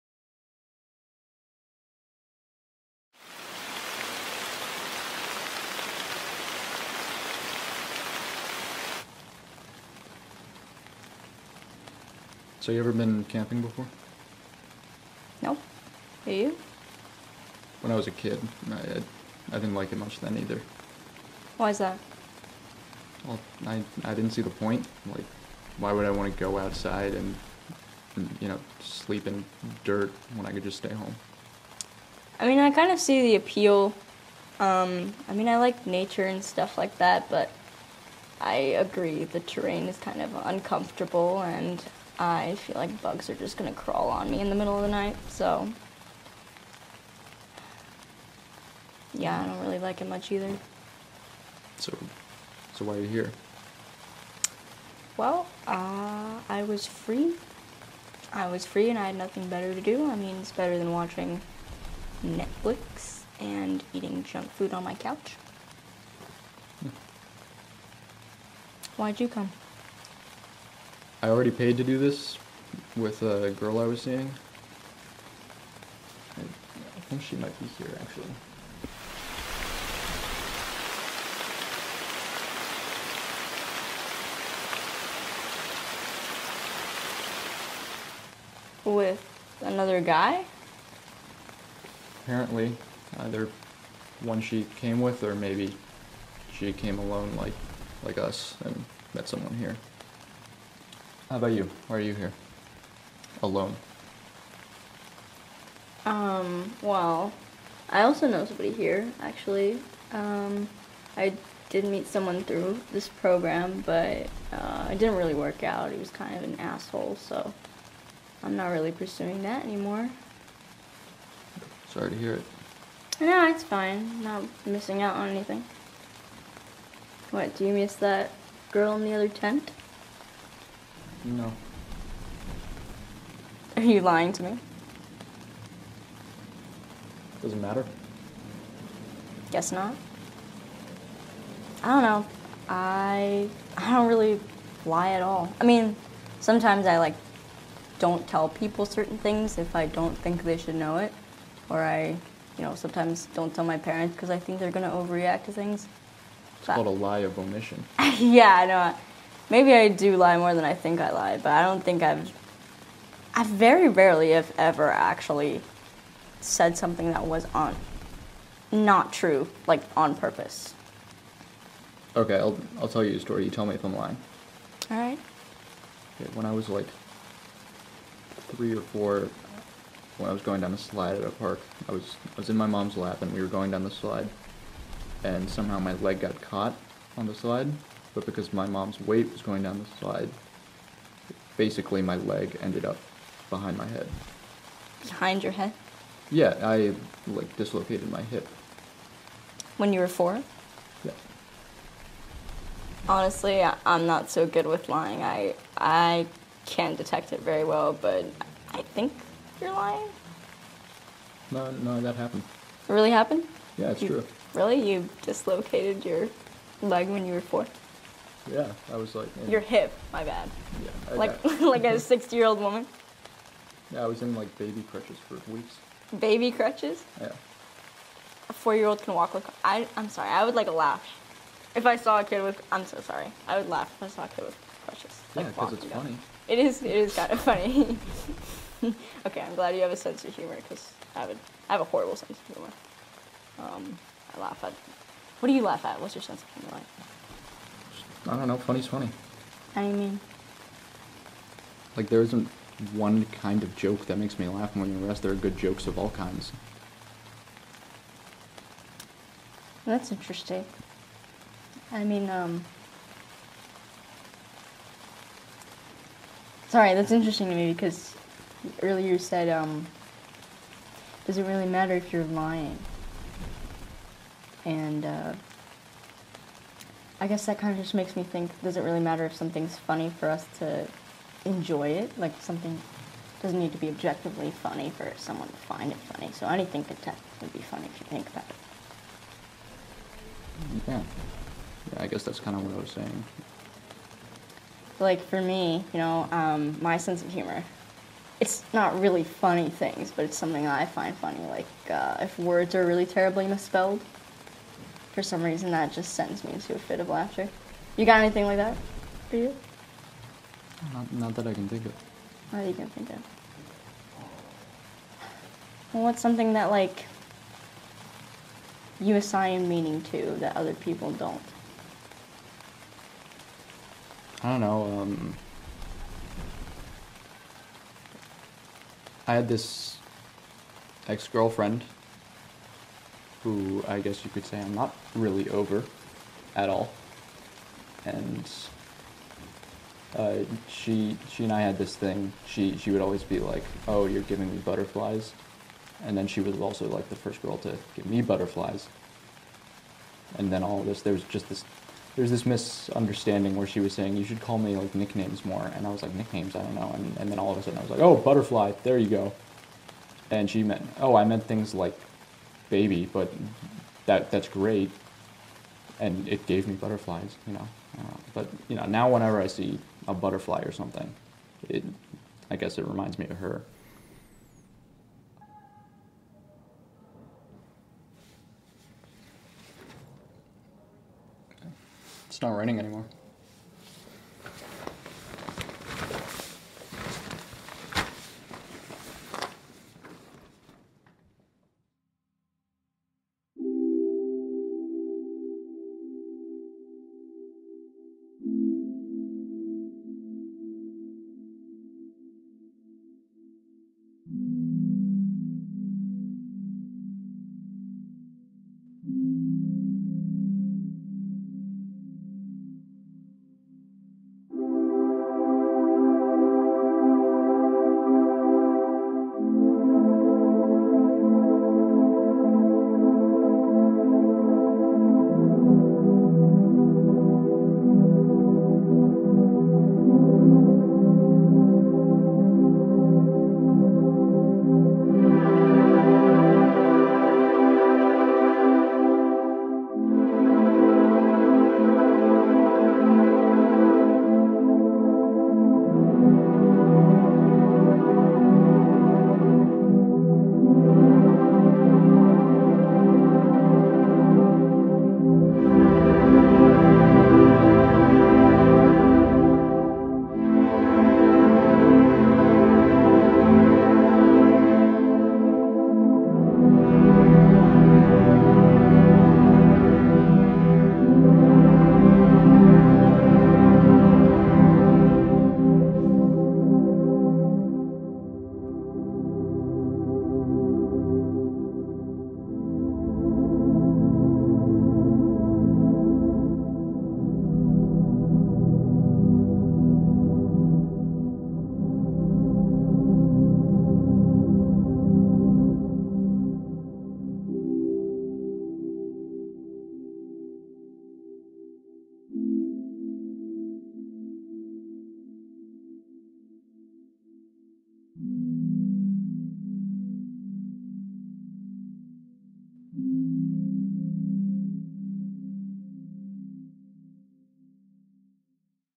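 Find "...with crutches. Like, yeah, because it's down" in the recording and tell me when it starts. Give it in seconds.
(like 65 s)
234 s.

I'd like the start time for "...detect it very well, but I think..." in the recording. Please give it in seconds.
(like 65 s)
206 s.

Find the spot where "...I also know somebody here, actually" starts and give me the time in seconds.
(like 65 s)
107 s.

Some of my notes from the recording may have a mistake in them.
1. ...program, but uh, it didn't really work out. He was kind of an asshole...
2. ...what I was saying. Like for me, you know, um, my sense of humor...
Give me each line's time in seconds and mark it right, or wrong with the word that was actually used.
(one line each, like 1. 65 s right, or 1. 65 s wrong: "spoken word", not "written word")
1. 113 s right
2. 292 s right.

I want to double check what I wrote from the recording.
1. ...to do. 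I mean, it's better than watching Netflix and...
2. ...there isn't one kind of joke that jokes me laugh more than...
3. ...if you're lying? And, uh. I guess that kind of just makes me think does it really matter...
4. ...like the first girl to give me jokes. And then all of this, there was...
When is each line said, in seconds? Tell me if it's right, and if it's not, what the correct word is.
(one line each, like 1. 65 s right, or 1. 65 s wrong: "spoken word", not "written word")
1. 59 s right
2. 252 s wrong: "makes", not "jokes"
3. 271 s right
4. 346 s wrong: "butterflies", not "jokes".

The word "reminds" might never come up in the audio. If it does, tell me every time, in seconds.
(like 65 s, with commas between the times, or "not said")
372 s.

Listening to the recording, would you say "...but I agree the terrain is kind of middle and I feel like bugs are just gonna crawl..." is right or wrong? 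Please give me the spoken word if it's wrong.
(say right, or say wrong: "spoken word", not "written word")
wrong: "uncomfortable", not "middle".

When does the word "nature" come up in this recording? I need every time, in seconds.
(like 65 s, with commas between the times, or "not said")
35 s.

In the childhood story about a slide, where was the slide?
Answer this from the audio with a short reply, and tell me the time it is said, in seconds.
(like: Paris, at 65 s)
a park, at 181 s.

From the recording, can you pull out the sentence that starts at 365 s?
And it gave me butterflies, you know.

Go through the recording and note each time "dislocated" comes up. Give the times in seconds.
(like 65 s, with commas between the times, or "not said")
197 s, 215 s.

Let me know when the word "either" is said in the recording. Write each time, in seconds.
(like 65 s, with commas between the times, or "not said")
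20 s, 50 s, 93 s.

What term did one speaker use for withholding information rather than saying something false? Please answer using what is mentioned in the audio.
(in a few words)
lie of omission.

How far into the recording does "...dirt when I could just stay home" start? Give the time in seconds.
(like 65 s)
29 s.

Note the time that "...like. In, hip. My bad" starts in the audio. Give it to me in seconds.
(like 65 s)
219 s.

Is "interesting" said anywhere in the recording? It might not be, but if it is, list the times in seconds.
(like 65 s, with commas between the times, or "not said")
260 s, 267 s.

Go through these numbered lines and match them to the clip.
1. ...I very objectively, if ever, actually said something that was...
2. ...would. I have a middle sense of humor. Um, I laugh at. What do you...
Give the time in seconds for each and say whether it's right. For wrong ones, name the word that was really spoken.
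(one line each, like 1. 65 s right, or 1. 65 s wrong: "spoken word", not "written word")
1. 163 s wrong: "rarely", not "objectively"
2. 241 s wrong: "horrible", not "middle".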